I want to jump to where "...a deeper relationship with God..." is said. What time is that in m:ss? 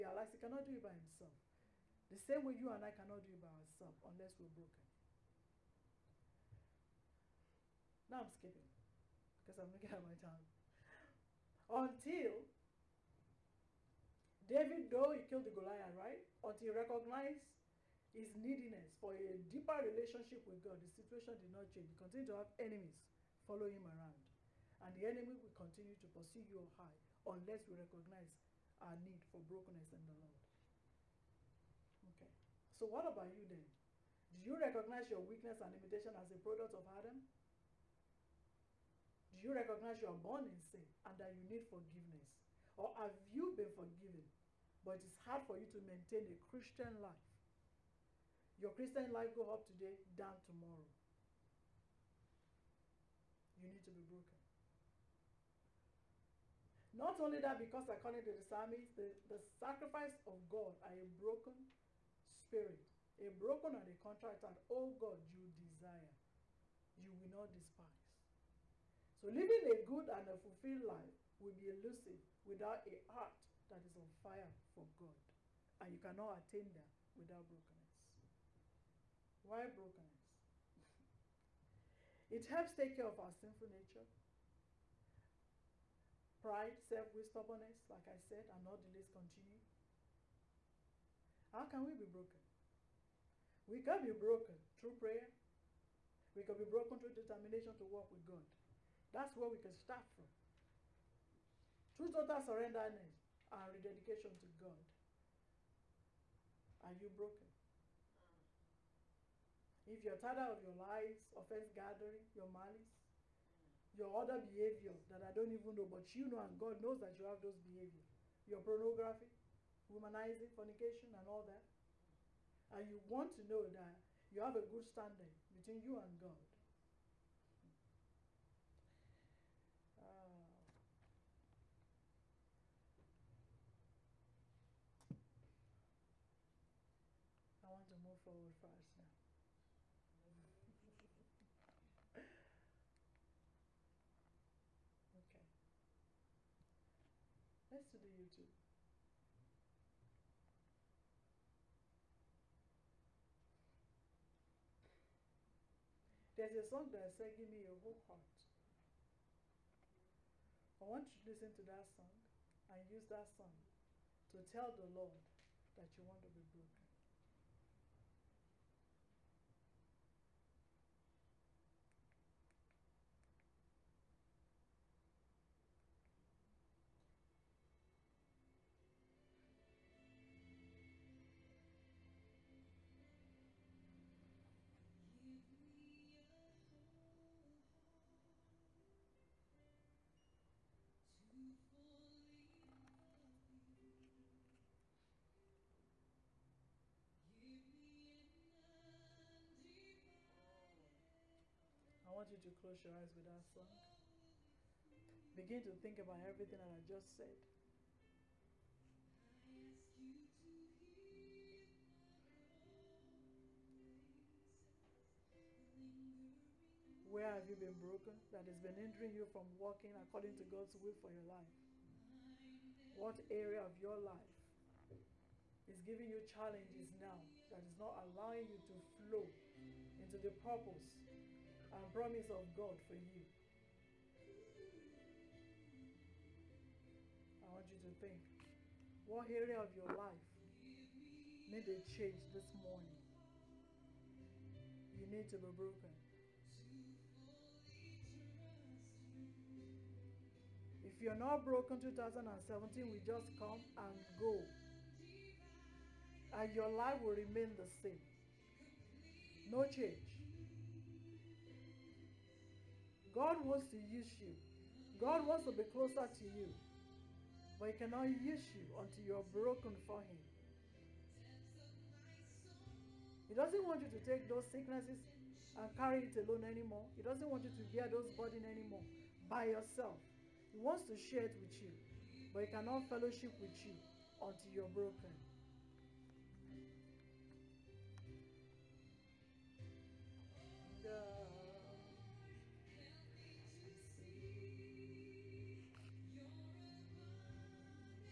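0:19.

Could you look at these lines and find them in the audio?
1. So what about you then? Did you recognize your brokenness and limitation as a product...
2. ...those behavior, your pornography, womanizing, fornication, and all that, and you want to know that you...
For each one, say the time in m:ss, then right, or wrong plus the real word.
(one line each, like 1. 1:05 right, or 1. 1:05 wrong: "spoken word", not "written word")
1. 0:32 wrong: "weakness", not "brokenness"
2. 1:57 right.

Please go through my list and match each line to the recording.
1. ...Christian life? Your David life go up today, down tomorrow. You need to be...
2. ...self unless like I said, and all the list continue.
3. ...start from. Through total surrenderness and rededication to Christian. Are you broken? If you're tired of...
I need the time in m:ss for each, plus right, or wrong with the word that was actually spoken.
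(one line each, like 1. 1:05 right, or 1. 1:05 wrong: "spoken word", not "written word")
1. 0:46 wrong: "Christian", not "David"
2. 1:26 wrong: "wisdomness", not "unless"
3. 1:39 wrong: "God", not "Christian".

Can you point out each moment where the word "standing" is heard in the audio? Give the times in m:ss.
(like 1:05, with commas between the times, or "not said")
2:04.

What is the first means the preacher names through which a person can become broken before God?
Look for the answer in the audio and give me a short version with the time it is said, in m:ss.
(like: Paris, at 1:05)
Prayer, at 1:34.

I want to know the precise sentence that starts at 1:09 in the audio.
So living a good and a fulfilled life will be elusive without a heart that is on fire for God.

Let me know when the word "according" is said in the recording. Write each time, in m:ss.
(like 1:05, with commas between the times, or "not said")
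0:57, 3:39.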